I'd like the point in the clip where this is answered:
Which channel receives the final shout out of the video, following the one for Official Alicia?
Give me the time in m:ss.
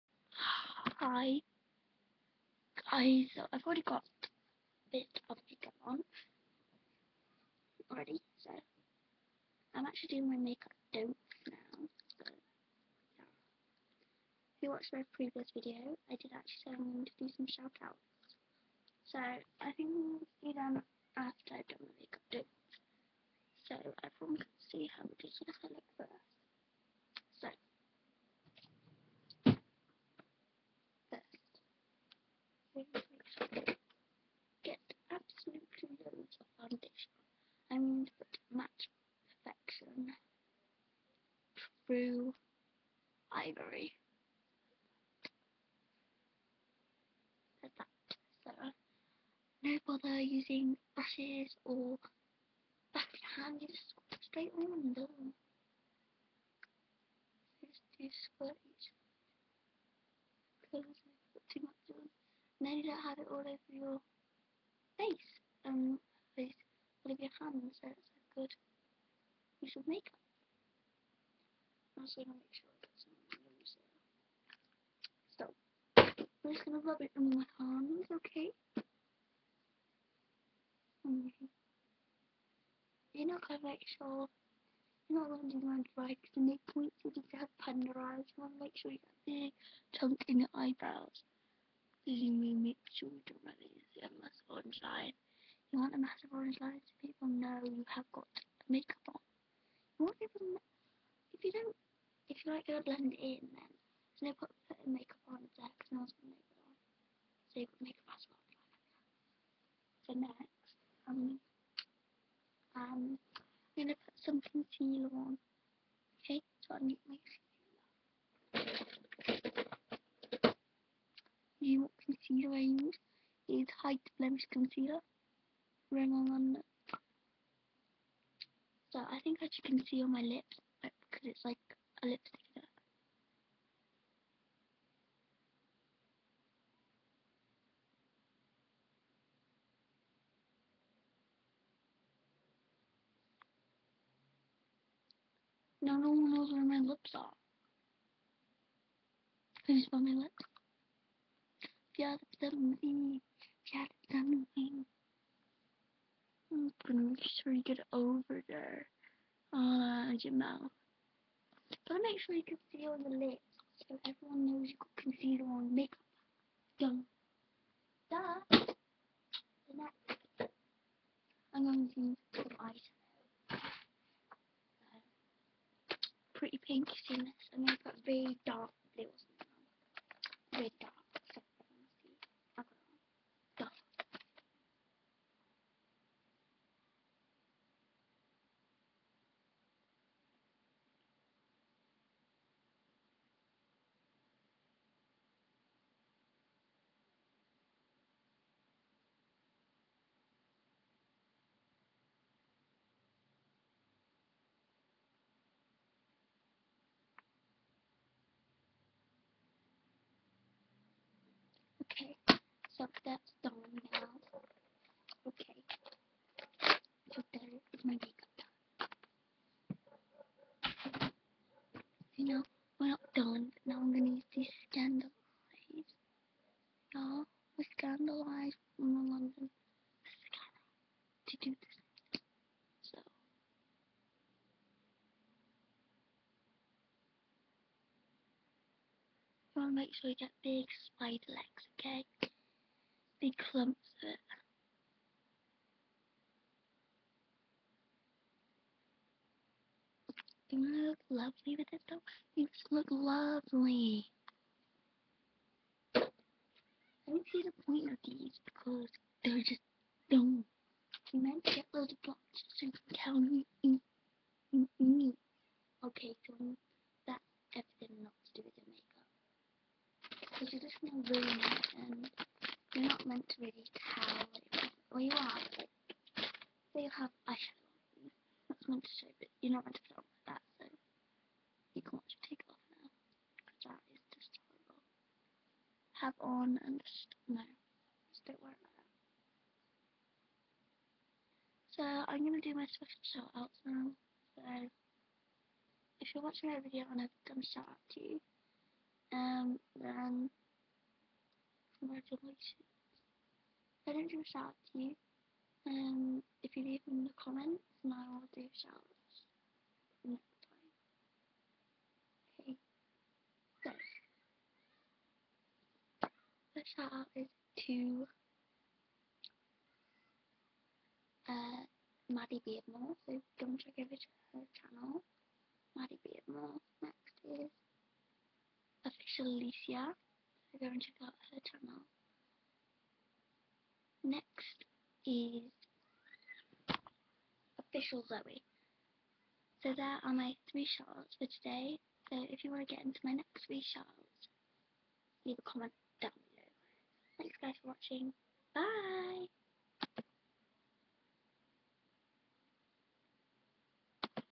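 5:37.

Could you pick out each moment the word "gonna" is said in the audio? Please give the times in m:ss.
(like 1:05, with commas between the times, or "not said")
1:16, 1:23, 2:36, 3:43.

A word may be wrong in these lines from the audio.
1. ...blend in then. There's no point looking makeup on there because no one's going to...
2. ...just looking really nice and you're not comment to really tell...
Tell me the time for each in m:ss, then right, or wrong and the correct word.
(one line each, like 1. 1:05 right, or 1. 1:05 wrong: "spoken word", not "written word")
1. 1:42 wrong: "putting", not "looking"
2. 4:30 wrong: "meant", not "comment".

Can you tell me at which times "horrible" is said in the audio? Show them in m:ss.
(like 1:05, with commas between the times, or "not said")
4:44.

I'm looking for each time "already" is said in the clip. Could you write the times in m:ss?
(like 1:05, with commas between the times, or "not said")
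0:03, 0:07.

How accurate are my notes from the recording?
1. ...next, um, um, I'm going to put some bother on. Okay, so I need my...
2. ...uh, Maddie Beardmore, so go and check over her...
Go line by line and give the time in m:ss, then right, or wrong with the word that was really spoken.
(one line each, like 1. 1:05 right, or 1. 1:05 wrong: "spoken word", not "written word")
1. 1:50 wrong: "concealer", not "bother"
2. 5:21 right.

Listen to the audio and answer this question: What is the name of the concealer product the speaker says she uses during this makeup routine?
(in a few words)
Height Blemish Concealer.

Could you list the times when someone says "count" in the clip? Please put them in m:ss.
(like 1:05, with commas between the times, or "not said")
4:23.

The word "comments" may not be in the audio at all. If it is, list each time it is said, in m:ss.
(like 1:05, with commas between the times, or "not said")
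5:07, 5:45.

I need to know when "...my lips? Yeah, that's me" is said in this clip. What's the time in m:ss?
2:29.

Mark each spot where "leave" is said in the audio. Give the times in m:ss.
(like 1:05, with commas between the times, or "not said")
5:06, 5:45.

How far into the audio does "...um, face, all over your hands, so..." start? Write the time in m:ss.
1:05.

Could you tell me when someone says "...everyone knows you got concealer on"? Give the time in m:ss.
2:44.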